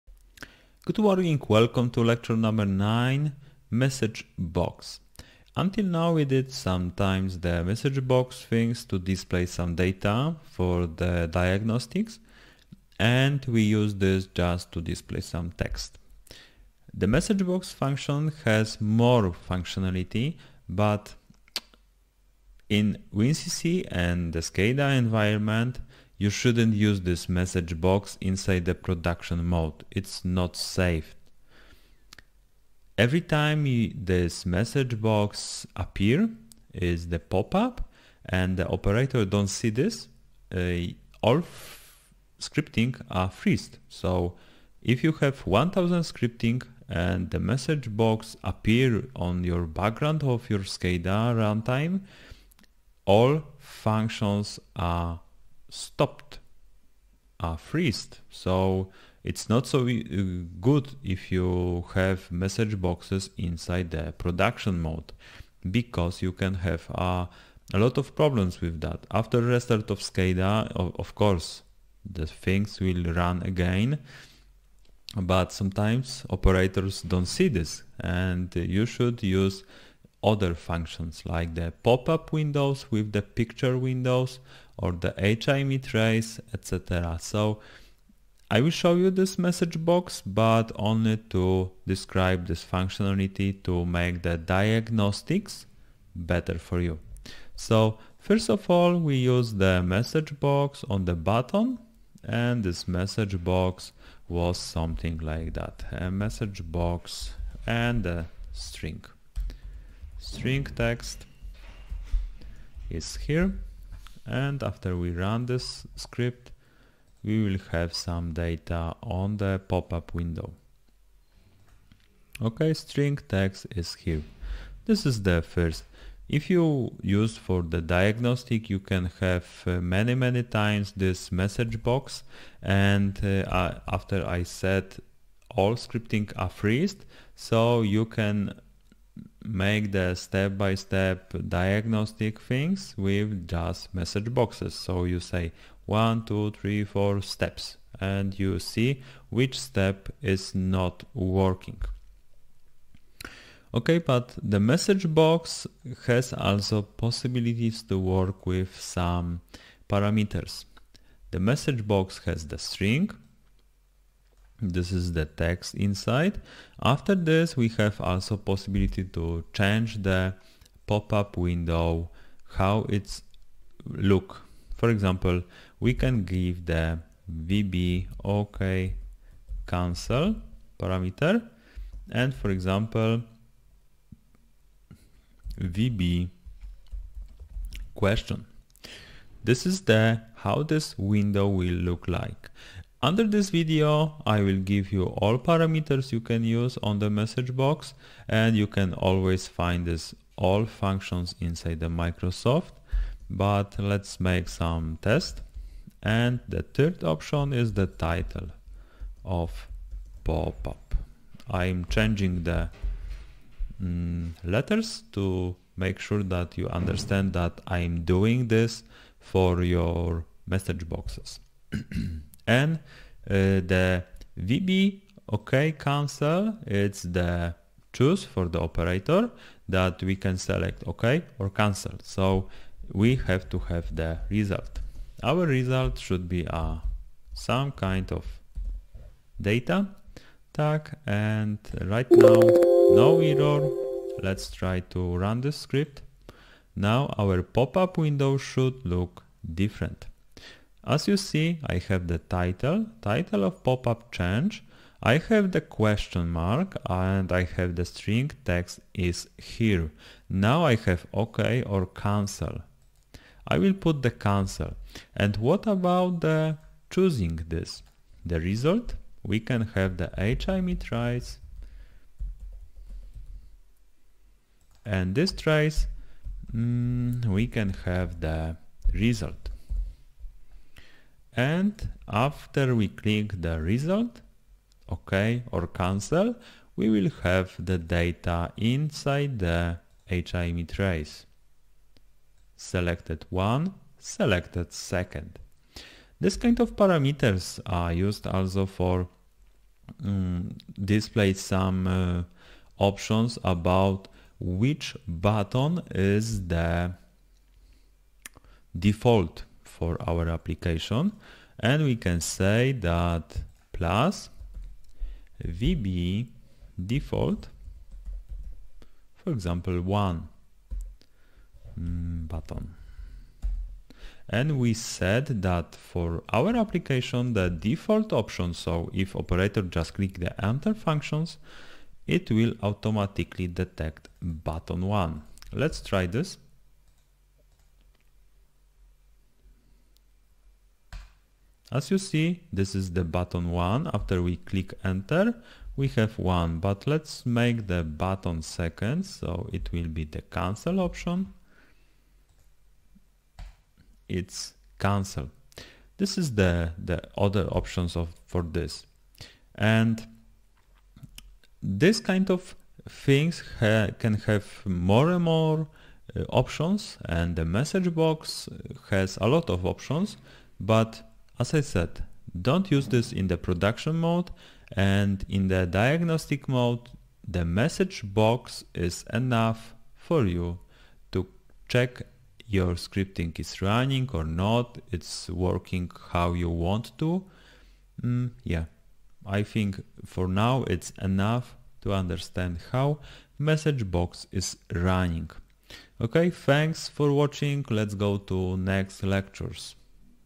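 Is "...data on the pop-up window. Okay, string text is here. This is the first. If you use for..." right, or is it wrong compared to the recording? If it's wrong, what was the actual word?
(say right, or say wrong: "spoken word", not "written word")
right.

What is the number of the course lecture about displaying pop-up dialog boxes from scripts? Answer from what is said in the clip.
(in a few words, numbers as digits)
9.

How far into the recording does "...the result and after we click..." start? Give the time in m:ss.
4:38.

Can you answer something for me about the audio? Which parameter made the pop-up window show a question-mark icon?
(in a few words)
vb question.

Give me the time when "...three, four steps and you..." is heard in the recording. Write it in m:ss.
2:26.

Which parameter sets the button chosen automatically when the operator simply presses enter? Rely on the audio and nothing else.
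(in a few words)
vb default.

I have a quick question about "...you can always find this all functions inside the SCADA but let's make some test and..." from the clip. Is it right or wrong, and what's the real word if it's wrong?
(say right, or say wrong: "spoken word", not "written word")
wrong: "Microsoft", not "SCADA".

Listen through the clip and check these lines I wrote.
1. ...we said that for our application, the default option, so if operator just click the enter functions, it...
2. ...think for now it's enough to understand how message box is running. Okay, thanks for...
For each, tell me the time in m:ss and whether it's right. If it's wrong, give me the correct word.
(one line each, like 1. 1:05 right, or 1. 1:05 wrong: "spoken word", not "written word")
1. 5:24 right
2. 6:29 right.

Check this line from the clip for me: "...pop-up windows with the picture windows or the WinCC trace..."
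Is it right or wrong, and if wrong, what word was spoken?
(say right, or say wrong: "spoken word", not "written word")
wrong: "HMI", not "WinCC".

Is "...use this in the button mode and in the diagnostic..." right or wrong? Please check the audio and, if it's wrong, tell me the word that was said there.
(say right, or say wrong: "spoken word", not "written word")
wrong: "production", not "button".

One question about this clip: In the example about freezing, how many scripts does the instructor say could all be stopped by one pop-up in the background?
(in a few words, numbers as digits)
1000.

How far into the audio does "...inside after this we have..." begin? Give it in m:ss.
2:45.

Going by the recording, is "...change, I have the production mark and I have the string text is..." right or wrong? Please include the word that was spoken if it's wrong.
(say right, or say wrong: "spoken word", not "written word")
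wrong: "question", not "production".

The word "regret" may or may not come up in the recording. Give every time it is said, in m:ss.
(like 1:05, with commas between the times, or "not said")
not said.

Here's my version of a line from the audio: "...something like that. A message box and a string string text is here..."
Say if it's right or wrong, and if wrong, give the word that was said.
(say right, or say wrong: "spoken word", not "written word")
right.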